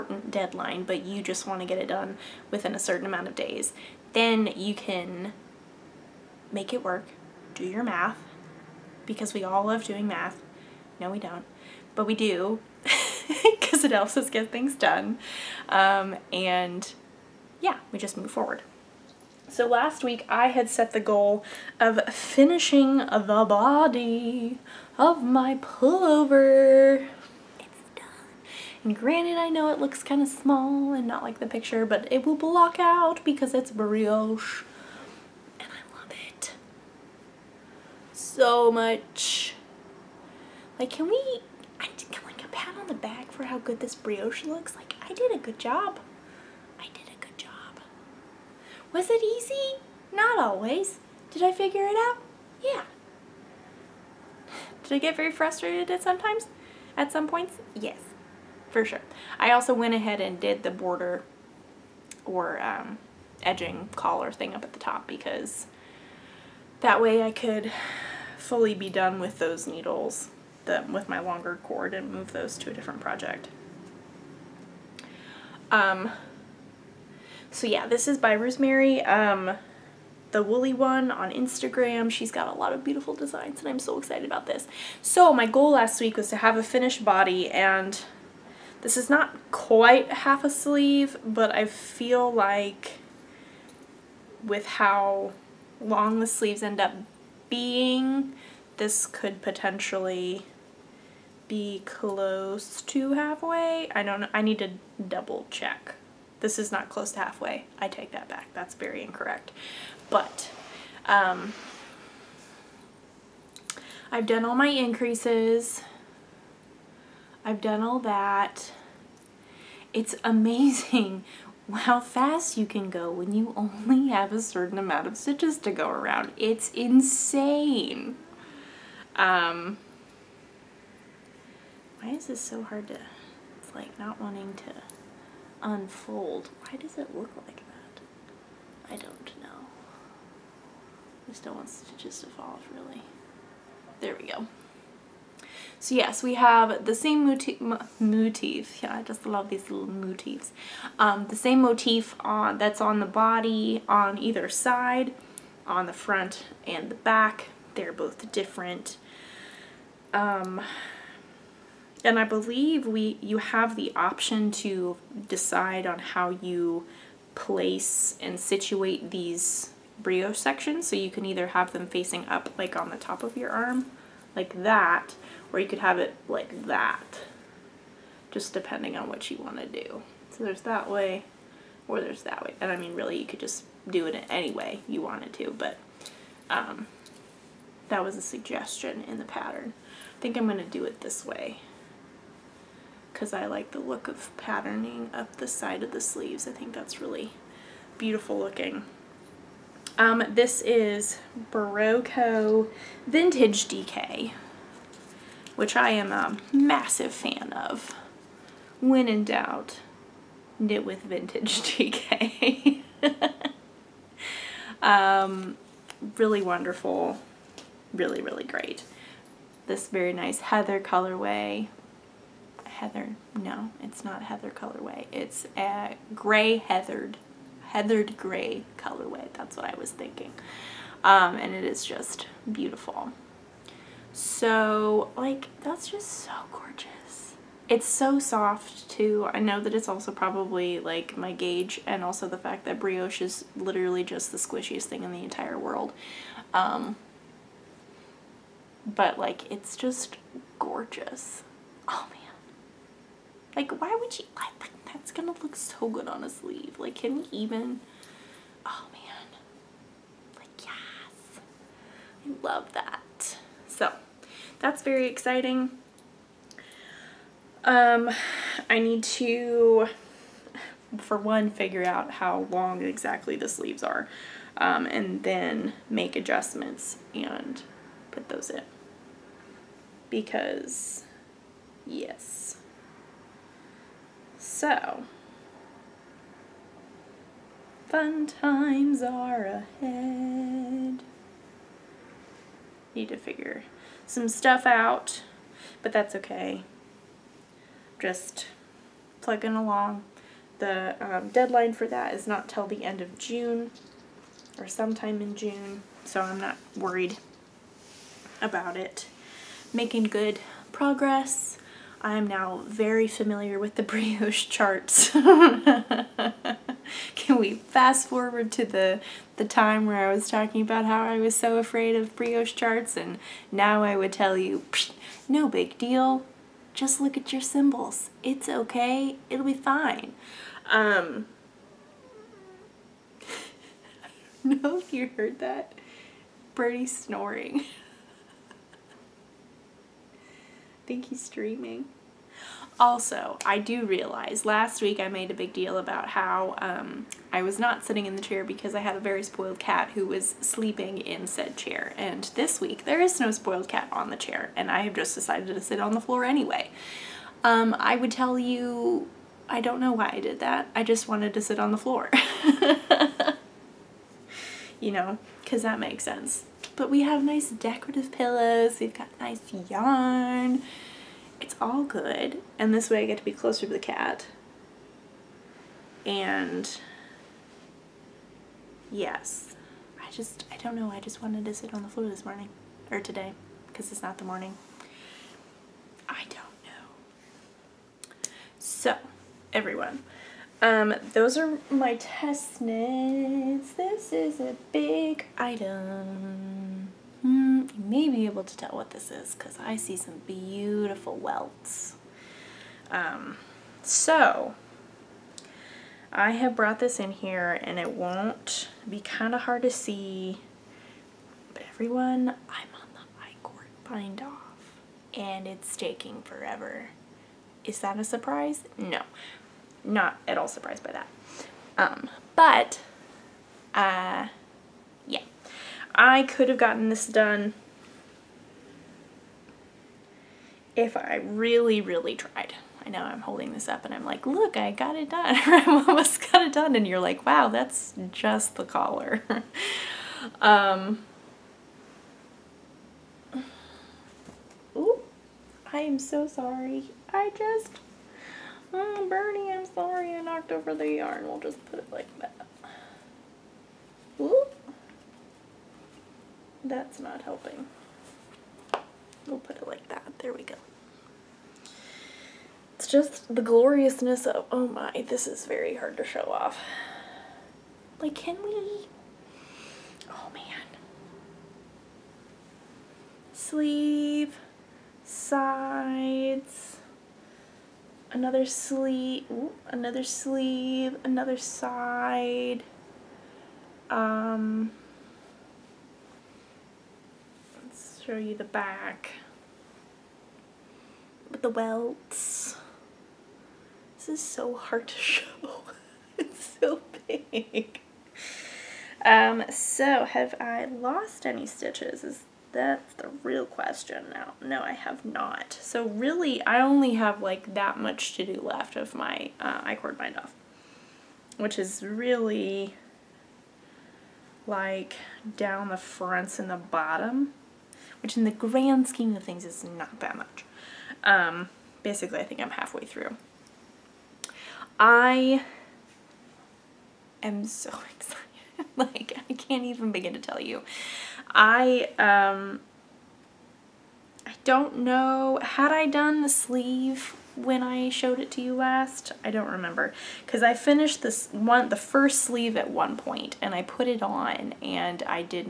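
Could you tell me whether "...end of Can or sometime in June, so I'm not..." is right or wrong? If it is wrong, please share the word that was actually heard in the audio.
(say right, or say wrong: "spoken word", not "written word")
wrong: "June", not "Can".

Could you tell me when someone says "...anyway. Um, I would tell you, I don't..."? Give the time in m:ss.
5:56.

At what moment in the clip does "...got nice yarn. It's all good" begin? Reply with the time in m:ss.
6:08.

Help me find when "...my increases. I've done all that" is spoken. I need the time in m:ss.
1:54.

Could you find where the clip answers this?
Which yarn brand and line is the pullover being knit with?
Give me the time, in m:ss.
3:21.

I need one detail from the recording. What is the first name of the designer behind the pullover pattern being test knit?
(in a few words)
Rosemary.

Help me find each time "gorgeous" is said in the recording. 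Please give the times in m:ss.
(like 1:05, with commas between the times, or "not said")
3:56, 4:10.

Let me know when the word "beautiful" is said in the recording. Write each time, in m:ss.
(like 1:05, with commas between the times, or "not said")
1:22, 3:17, 3:52, 6:40.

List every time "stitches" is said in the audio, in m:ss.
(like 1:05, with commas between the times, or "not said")
2:05, 2:21, 8:21.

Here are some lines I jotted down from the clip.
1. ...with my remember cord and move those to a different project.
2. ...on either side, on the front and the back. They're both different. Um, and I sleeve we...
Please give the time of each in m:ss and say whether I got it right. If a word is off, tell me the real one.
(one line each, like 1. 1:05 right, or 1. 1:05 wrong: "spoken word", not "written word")
1. 1:10 wrong: "longer", not "remember"
2. 2:33 wrong: "believe", not "sleeve".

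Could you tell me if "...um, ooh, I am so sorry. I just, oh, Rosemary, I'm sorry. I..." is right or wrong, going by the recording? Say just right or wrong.
wrong.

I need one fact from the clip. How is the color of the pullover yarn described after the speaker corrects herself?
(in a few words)
Heathered gray.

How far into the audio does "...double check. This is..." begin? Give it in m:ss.
1:45.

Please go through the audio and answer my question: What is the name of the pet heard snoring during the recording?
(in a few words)
Birdie.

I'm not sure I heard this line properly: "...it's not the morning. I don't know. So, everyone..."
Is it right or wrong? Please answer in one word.
right.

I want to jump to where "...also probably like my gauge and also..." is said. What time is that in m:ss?
3:59.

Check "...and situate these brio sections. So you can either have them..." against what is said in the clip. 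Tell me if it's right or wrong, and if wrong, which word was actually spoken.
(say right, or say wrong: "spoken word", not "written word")
right.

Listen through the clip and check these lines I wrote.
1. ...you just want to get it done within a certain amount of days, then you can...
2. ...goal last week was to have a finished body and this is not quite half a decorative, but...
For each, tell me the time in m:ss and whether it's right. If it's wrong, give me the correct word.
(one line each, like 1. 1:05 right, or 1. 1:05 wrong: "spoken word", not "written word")
1. 0:01 right
2. 1:25 wrong: "sleeve", not "decorative".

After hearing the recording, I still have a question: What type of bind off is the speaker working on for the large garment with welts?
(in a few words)
I-cord bind off.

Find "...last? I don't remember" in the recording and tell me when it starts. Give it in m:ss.
8:58.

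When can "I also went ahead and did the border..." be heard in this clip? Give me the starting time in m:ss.
0:59.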